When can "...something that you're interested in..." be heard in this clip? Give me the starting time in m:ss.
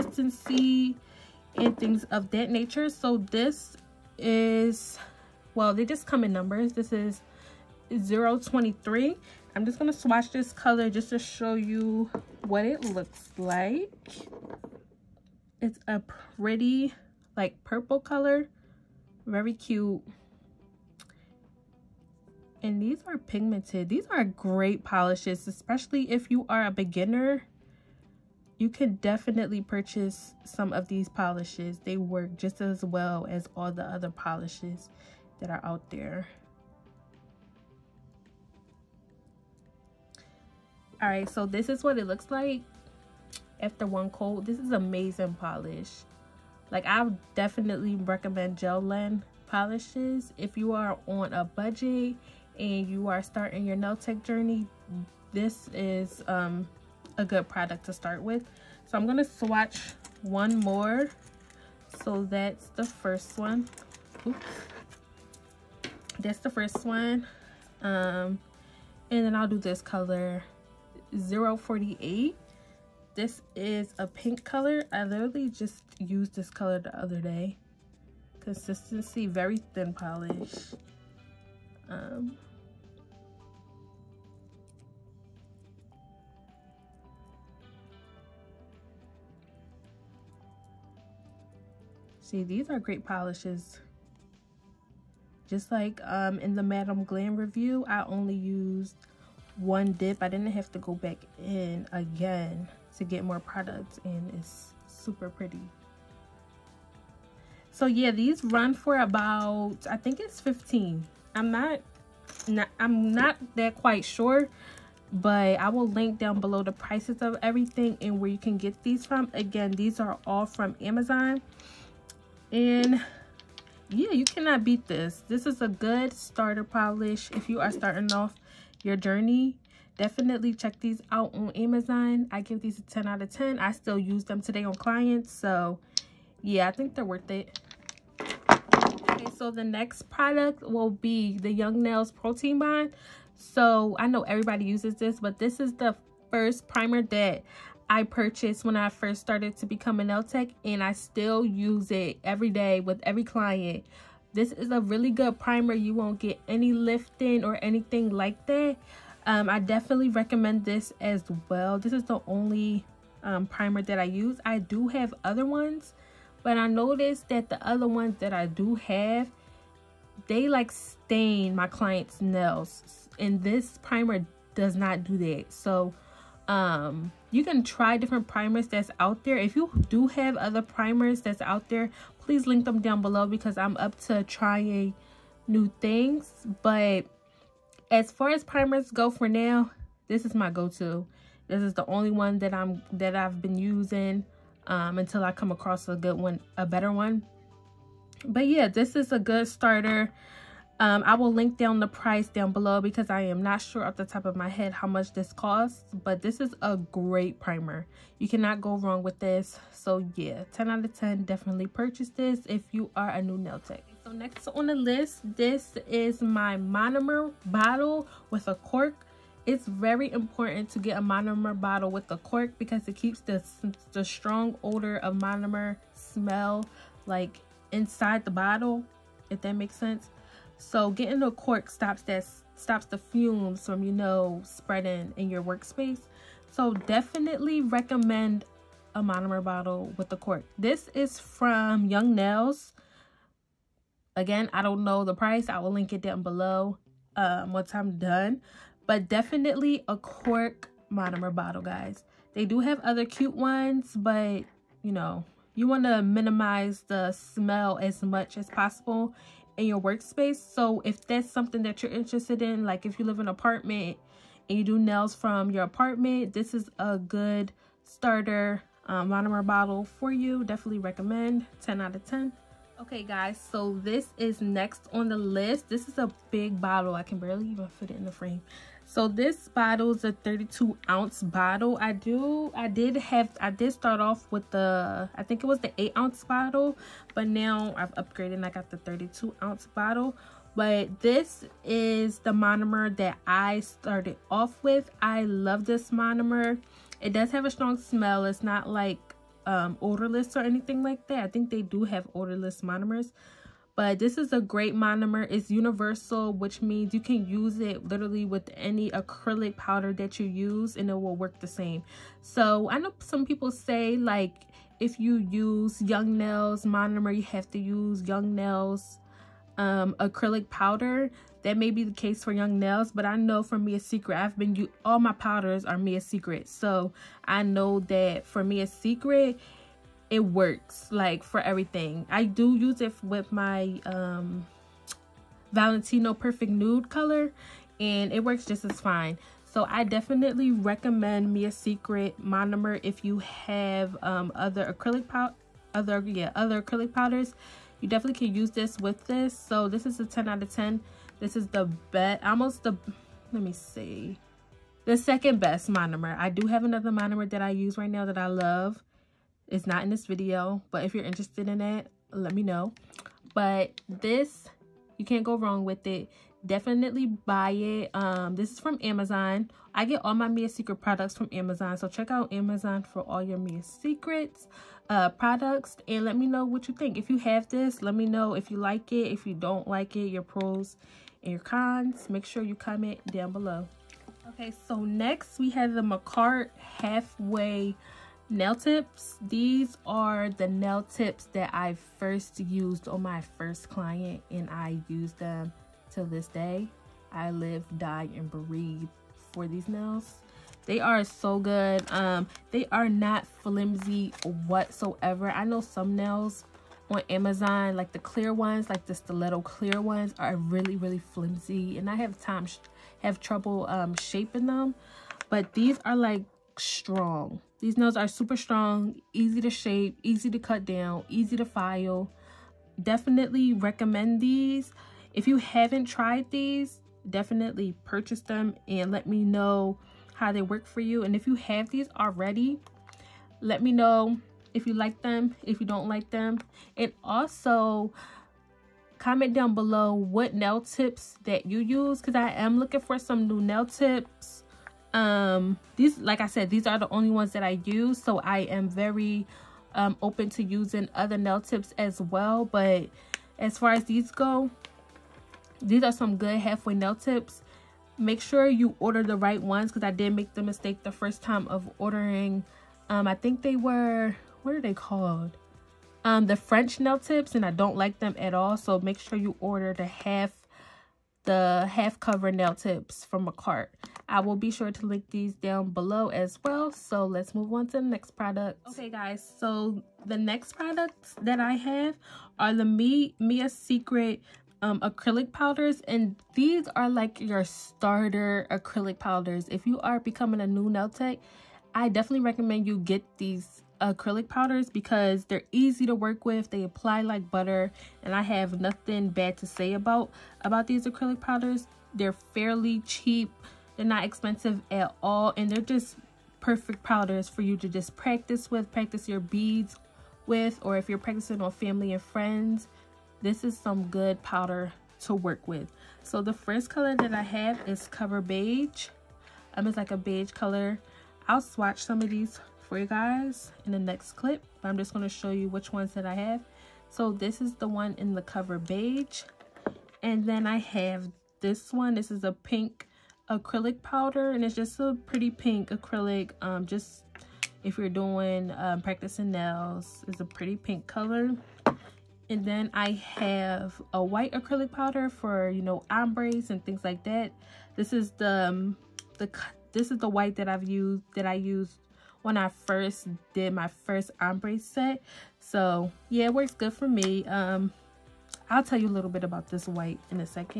4:21.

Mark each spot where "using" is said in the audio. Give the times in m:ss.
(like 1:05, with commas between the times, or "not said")
3:13, 7:30.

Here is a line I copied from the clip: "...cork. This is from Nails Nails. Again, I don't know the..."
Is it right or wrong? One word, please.
wrong.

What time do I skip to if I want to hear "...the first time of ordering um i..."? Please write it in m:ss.
7:40.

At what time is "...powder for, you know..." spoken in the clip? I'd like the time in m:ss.
9:04.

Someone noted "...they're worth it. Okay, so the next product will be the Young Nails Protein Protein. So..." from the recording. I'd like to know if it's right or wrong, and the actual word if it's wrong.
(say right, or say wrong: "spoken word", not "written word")
wrong: "Bond", not "Protein".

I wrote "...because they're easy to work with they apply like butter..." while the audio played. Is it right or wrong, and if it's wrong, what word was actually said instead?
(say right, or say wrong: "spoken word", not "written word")
right.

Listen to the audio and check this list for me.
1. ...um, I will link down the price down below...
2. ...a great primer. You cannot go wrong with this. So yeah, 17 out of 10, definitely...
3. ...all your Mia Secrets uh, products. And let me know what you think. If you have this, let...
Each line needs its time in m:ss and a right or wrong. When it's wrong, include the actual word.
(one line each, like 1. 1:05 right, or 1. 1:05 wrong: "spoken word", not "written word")
1. 3:20 right
2. 3:26 wrong: "10", not "17"
3. 6:13 right.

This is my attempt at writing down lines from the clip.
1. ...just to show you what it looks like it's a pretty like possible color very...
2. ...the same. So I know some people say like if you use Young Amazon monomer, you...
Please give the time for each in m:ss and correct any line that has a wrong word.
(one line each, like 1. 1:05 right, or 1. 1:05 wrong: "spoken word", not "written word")
1. 0:10 wrong: "purple", not "possible"
2. 5:11 wrong: "Nails", not "Amazon".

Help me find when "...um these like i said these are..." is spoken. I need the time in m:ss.
7:24.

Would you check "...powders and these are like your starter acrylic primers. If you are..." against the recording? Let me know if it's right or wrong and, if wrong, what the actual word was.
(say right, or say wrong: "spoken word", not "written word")
wrong: "powders", not "primers".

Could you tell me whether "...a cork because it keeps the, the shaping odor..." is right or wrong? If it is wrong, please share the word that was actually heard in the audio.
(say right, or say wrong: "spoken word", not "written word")
wrong: "strong", not "shaping".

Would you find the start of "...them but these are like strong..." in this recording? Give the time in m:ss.
6:54.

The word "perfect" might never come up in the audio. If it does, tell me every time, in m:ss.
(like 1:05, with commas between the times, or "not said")
5:36, 8:26.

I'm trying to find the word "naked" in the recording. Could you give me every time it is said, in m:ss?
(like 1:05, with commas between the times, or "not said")
not said.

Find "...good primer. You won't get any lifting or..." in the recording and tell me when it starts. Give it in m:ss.
2:35.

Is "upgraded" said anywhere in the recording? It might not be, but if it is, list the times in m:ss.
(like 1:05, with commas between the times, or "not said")
4:48.